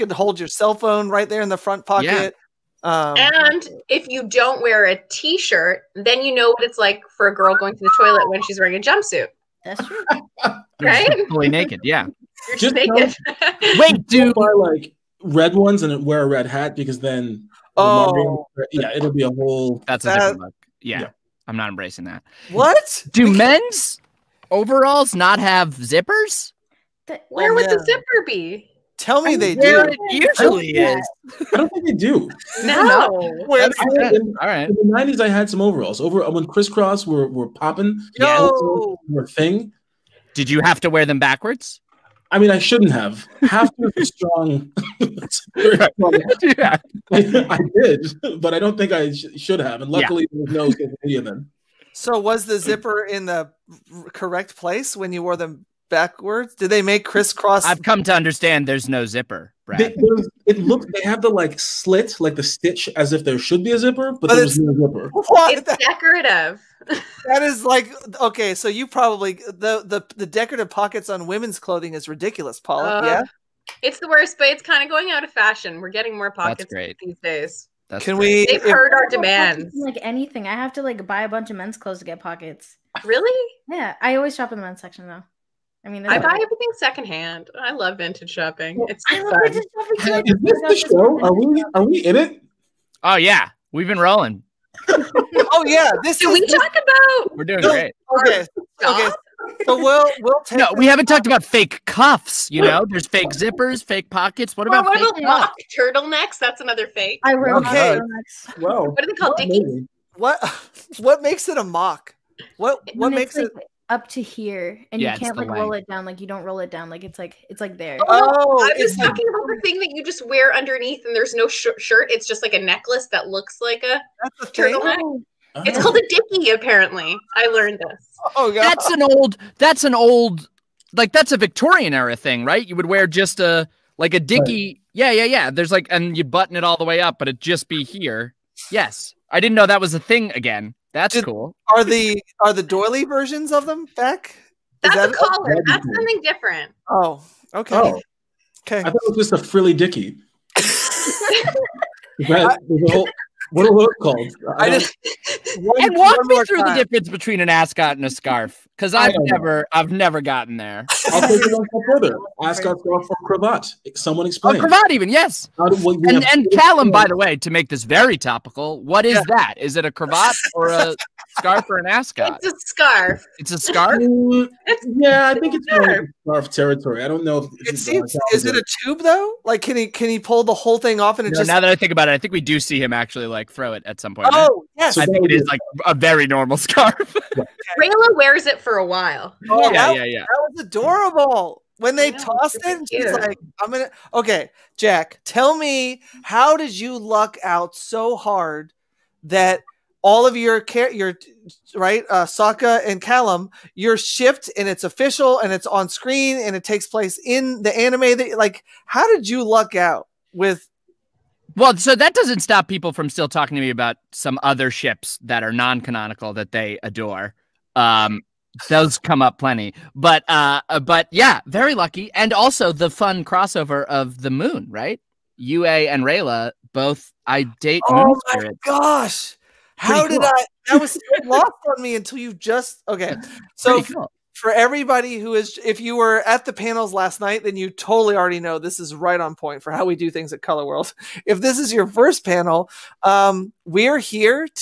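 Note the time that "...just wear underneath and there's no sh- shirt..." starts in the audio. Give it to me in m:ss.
2:00.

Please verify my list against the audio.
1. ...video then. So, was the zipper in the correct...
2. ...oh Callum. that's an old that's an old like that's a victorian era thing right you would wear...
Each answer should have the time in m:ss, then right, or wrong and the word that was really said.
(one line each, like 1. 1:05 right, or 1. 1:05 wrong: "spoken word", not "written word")
1. 0:51 right
2. 2:08 wrong: "God", not "Callum".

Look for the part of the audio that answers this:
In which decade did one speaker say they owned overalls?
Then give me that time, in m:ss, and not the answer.
0:34.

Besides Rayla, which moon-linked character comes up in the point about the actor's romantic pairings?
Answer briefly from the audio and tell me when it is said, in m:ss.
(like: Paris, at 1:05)
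Yue, at 3:45.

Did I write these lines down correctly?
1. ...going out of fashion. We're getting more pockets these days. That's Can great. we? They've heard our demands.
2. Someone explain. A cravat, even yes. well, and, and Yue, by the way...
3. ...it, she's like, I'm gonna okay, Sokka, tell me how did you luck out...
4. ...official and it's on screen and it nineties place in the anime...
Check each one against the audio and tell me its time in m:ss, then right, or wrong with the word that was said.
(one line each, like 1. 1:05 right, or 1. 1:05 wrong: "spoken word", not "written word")
1. 1:14 right
2. 2:43 wrong: "Callum", not "Yue"
3. 3:12 wrong: "Jack", not "Sokka"
4. 3:24 wrong: "takes", not "nineties".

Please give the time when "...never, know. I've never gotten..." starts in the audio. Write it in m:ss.
2:39.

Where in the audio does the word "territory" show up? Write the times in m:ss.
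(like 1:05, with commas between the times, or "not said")
2:56.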